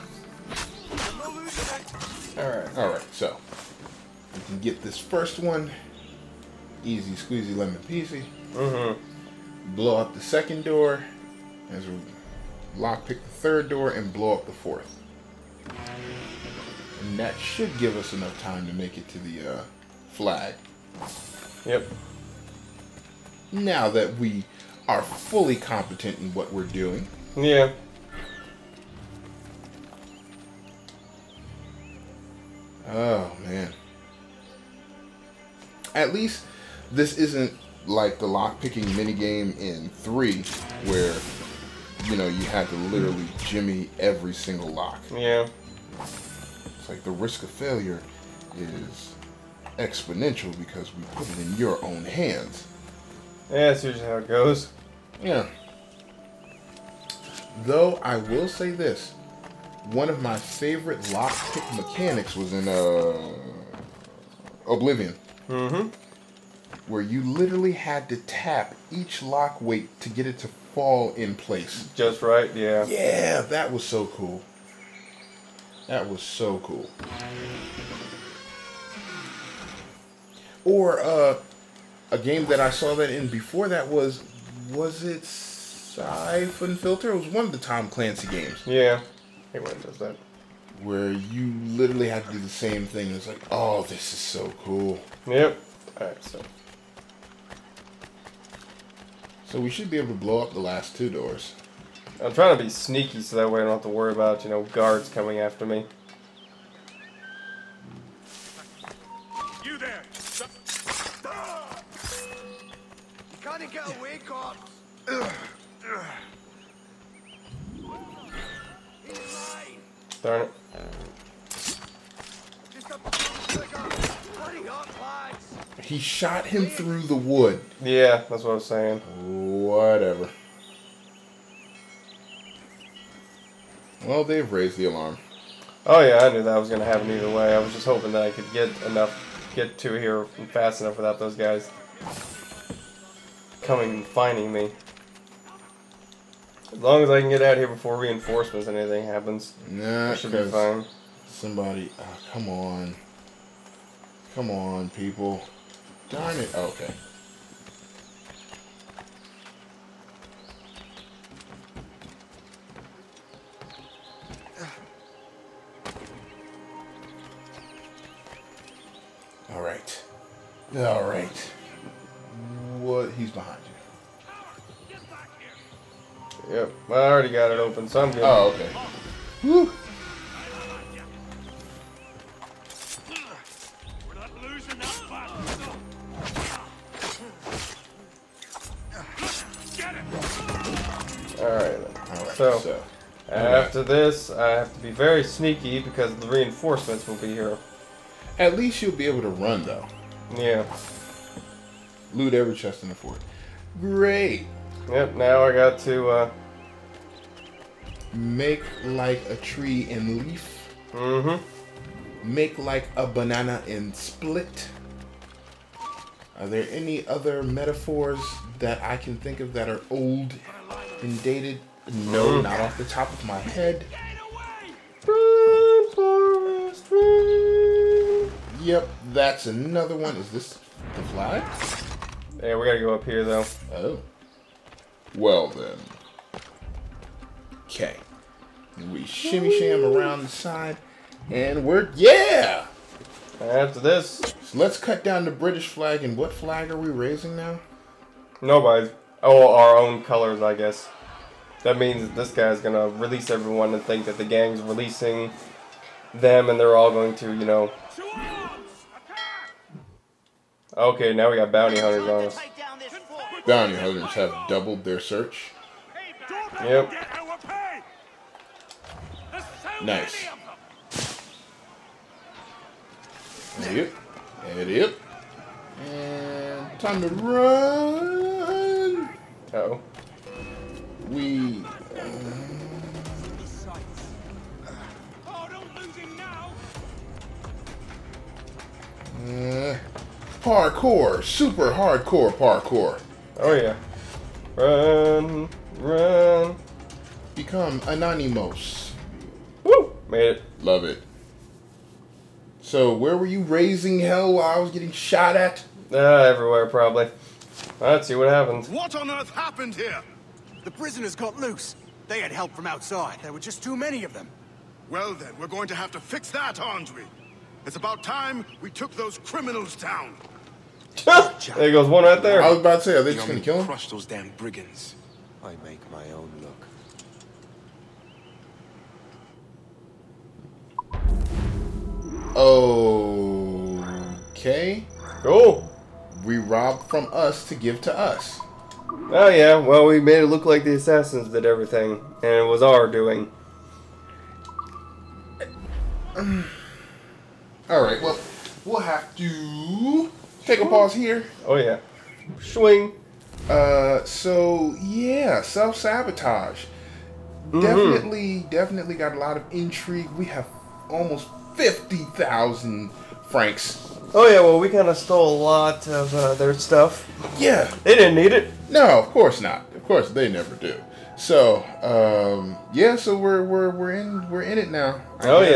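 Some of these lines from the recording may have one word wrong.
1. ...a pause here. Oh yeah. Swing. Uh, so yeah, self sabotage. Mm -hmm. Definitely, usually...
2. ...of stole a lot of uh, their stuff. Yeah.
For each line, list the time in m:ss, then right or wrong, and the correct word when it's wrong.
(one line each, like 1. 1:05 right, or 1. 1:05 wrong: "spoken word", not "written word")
1. 5:50 wrong: "definitely", not "usually"
2. 6:04 right.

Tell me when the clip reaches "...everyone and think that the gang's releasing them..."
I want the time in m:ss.
4:13.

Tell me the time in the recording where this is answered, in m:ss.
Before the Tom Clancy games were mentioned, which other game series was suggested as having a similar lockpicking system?
1:25.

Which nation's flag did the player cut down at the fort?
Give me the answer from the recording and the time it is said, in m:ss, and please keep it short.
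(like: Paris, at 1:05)
British, at 4:05.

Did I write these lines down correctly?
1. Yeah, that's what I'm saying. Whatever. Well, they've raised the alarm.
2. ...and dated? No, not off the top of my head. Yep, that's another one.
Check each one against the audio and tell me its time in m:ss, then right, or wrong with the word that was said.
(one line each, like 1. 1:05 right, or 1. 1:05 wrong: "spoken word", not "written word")
1. 2:07 right
2. 3:41 right.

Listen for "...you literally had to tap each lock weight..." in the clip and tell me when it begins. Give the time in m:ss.
1:07.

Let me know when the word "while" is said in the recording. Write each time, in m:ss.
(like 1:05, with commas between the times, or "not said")
5:04.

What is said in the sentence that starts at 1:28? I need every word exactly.
Yeah, everyone does that where you literally have to do the same thing.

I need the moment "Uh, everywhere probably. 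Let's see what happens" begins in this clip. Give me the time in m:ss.
5:05.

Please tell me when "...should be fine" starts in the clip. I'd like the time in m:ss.
2:30.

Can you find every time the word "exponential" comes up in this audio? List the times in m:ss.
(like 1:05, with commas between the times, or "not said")
0:49.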